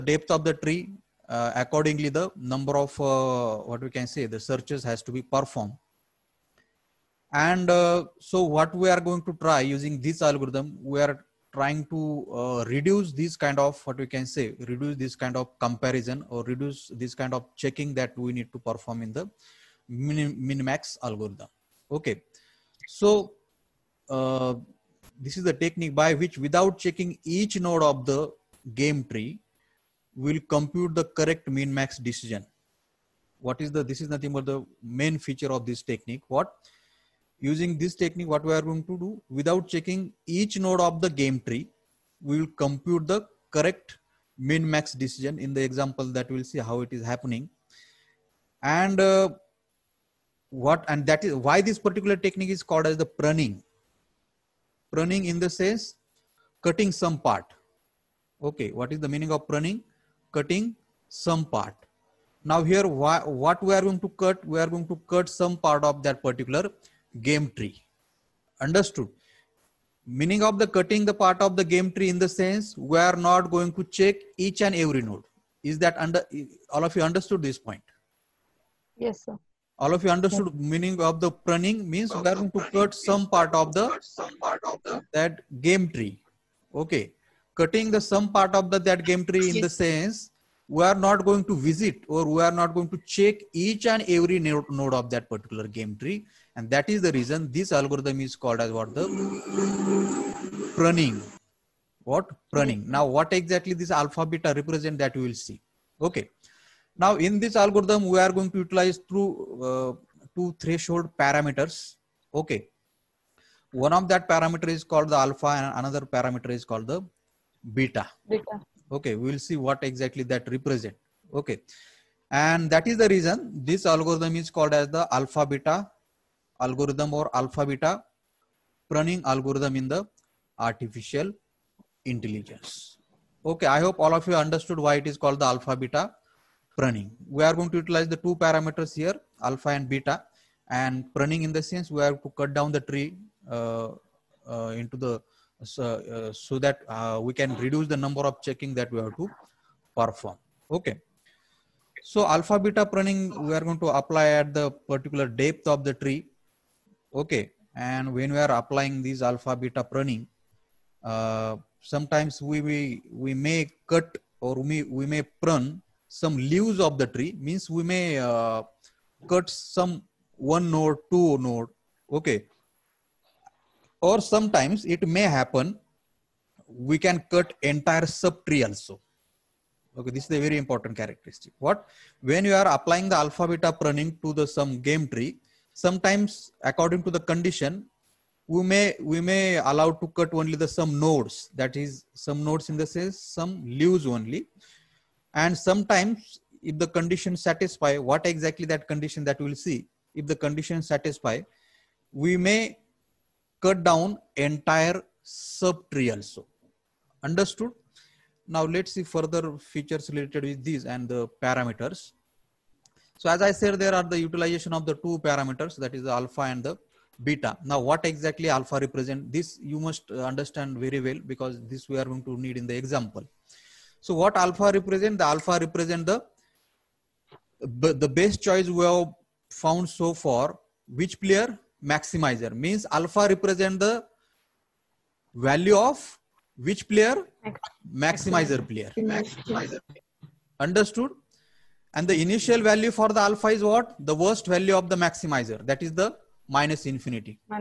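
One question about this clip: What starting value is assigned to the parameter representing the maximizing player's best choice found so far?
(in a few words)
minus infinity.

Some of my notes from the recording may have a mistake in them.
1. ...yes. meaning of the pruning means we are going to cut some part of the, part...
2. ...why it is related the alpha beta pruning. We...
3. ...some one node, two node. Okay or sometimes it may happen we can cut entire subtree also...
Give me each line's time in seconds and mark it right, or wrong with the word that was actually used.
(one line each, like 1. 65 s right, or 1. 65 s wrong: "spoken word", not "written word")
1. 80 s right
2. 134 s wrong: "called", not "related"
3. 169 s right.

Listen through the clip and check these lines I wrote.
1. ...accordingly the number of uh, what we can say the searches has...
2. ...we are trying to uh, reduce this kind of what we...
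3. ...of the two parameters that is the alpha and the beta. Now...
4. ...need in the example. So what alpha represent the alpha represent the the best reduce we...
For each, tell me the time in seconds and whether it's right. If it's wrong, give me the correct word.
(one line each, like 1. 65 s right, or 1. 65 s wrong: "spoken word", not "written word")
1. 1 s right
2. 10 s right
3. 214 s right
4. 222 s wrong: "choice", not "reduce".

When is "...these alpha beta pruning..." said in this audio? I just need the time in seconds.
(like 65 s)
159 s.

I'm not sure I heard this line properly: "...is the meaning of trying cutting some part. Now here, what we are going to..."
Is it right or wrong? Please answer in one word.
wrong.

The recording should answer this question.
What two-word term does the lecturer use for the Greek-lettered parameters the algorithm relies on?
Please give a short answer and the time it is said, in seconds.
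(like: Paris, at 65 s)
threshold parameters, at 110 s.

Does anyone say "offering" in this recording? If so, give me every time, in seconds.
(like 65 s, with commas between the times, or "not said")
not said.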